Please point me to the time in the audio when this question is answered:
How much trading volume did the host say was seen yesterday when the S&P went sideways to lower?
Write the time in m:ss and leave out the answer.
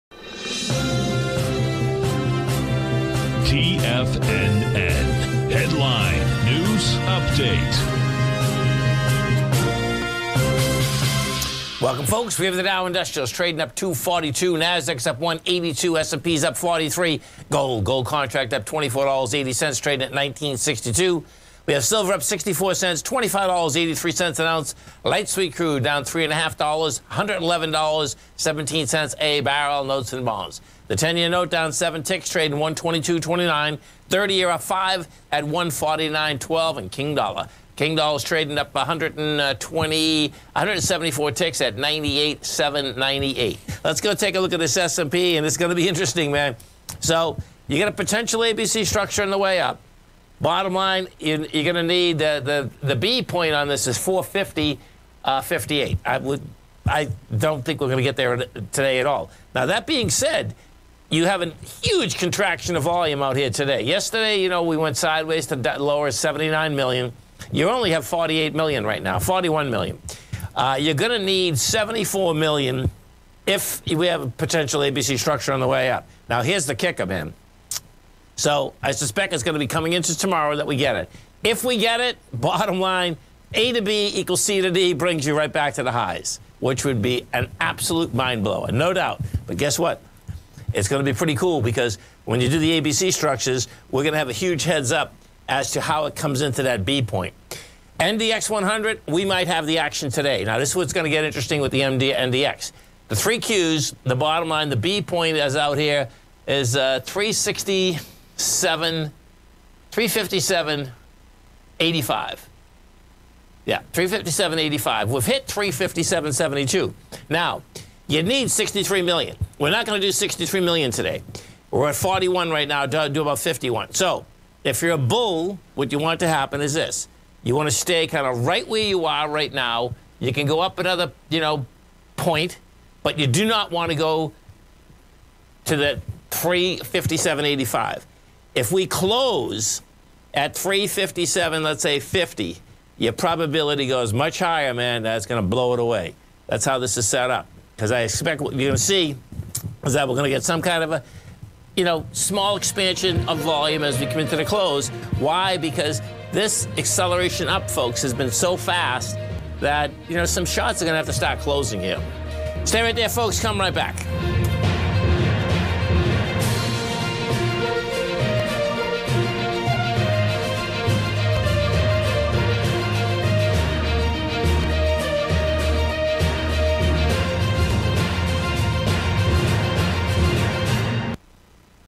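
1:06.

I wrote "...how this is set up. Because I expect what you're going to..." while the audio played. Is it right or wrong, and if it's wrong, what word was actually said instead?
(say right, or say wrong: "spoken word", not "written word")
right.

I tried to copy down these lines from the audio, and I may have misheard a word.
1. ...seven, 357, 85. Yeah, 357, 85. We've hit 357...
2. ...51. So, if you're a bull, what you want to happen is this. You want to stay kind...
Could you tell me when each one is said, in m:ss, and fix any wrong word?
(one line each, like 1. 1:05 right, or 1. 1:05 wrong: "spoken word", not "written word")
1. 1:48 right
2. 2:03 right.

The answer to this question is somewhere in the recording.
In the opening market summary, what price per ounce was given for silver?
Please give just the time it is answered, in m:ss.
0:23.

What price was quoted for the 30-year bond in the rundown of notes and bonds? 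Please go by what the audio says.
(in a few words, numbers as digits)
149.12.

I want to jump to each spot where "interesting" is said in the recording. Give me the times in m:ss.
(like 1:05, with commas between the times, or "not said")
0:45, 1:41.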